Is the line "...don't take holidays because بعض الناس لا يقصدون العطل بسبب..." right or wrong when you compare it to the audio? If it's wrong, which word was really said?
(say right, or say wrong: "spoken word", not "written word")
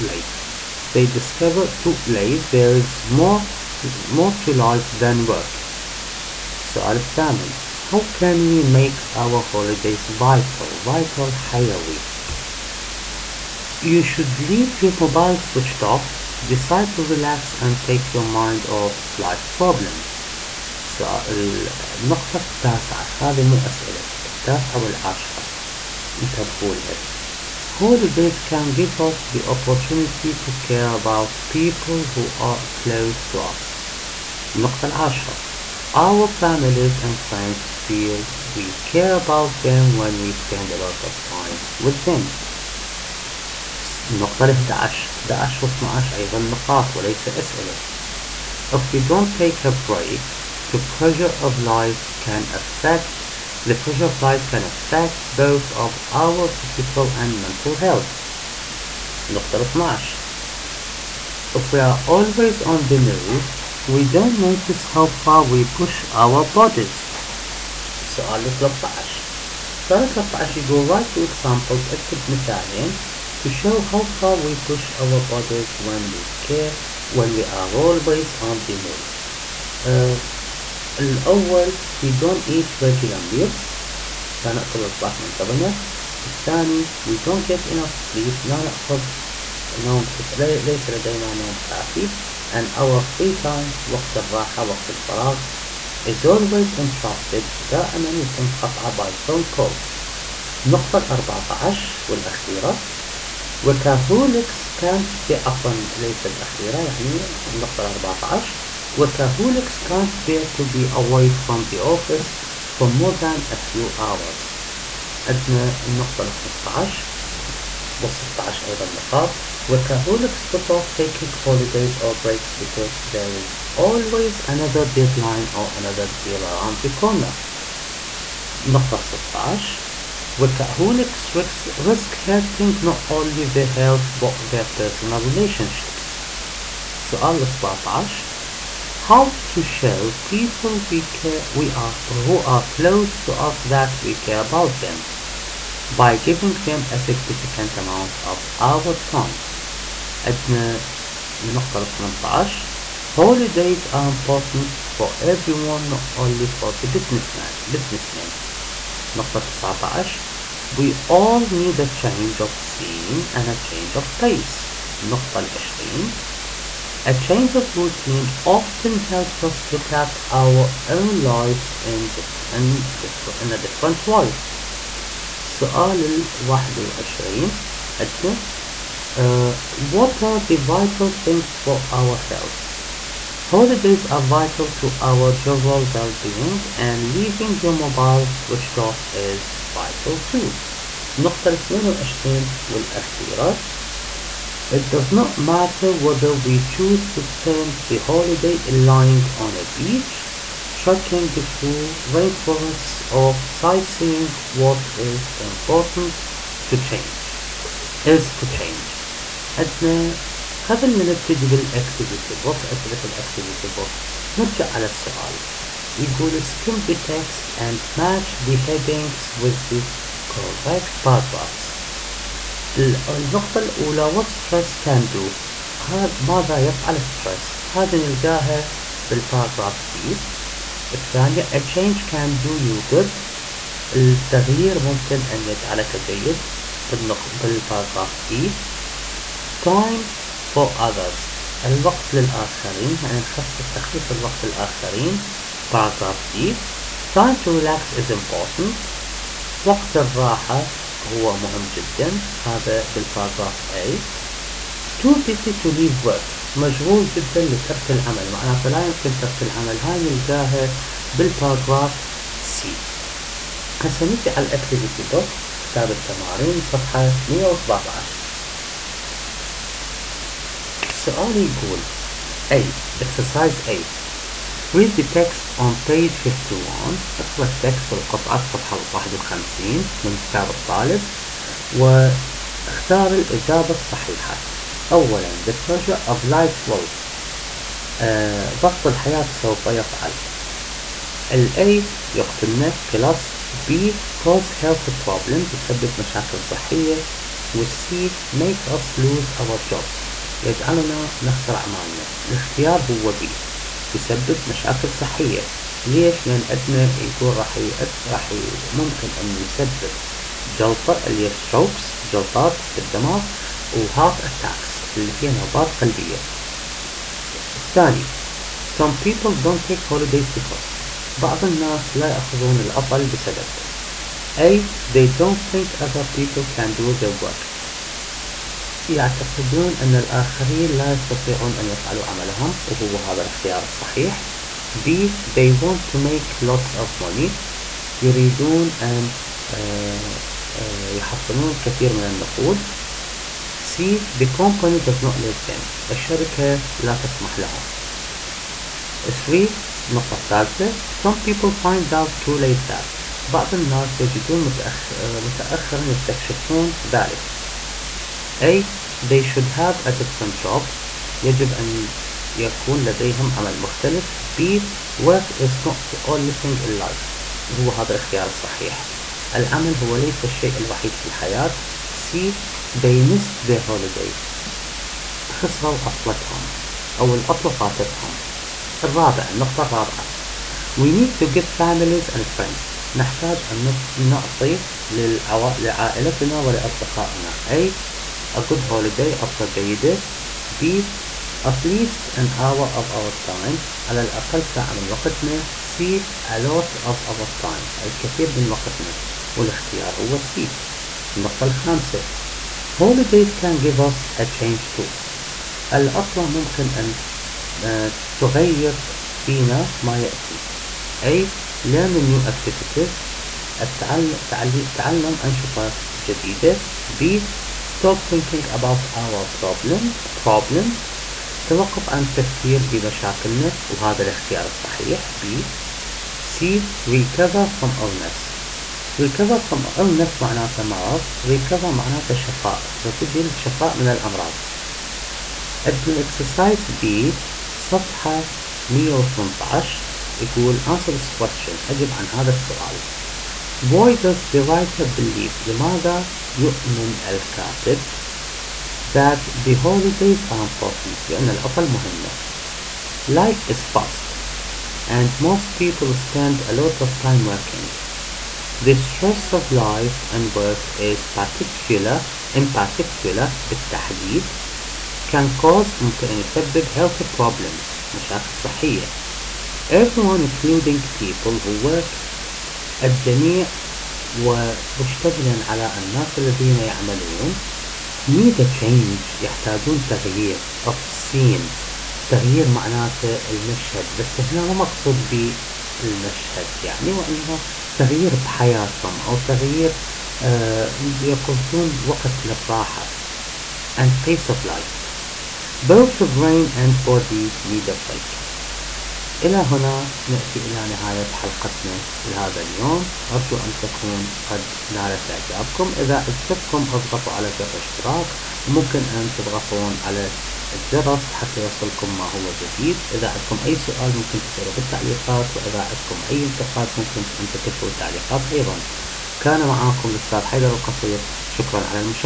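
wrong: "يأخذون", not "يقصدون".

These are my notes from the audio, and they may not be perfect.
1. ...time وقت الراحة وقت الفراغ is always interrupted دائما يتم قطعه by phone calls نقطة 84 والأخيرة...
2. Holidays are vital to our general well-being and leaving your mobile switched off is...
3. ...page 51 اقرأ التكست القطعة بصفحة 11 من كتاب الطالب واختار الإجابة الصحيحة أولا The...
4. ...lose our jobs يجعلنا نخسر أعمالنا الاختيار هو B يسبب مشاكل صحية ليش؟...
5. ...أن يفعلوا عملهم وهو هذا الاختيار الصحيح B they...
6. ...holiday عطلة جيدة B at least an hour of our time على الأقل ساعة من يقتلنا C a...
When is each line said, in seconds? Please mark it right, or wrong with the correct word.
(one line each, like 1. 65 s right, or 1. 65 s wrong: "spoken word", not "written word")
1. 93 s wrong: "14", not "84"
2. 183 s right
3. 275 s wrong: "51", not "11"
4. 298 s right
5. 331 s right
6. 388 s wrong: "وقتنا", not "يقتلنا".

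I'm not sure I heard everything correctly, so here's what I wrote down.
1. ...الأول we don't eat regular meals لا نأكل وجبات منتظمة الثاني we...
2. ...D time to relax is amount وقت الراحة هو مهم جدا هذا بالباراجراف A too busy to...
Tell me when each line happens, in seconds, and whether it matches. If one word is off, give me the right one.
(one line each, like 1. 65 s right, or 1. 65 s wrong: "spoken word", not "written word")
1. 80 s right
2. 246 s wrong: "important", not "amount".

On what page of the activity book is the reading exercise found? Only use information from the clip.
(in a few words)
117.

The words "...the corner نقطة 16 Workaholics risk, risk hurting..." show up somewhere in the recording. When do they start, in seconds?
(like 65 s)
126 s.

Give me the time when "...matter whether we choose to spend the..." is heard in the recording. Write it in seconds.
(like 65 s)
195 s.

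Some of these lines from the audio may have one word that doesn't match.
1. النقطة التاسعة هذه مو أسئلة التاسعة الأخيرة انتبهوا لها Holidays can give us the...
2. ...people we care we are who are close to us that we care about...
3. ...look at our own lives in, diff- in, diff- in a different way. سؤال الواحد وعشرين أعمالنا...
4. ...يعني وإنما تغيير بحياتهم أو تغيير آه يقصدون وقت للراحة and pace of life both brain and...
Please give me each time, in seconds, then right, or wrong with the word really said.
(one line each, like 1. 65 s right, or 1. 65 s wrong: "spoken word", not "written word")
1. 21 s wrong: "والعاشرة", not "الأخيرة"
2. 140 s right
3. 169 s wrong: "عندنا", not "أعمالنا"
4. 486 s right.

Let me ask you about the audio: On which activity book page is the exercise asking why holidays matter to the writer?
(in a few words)
118.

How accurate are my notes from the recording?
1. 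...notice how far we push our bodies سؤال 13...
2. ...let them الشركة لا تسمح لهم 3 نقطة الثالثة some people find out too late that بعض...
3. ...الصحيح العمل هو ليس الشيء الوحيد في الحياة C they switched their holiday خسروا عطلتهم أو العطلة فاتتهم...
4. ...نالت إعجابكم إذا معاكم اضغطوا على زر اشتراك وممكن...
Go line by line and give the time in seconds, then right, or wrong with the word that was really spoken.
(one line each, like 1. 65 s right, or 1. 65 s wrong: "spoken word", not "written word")
1. 64 s right
2. 345 s right
3. 368 s wrong: "missed", not "switched"
4. 504 s wrong: "أعجبتكم", not "معاكم".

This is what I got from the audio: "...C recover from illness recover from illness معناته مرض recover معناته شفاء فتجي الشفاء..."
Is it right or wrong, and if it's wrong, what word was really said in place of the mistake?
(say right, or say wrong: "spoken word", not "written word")
right.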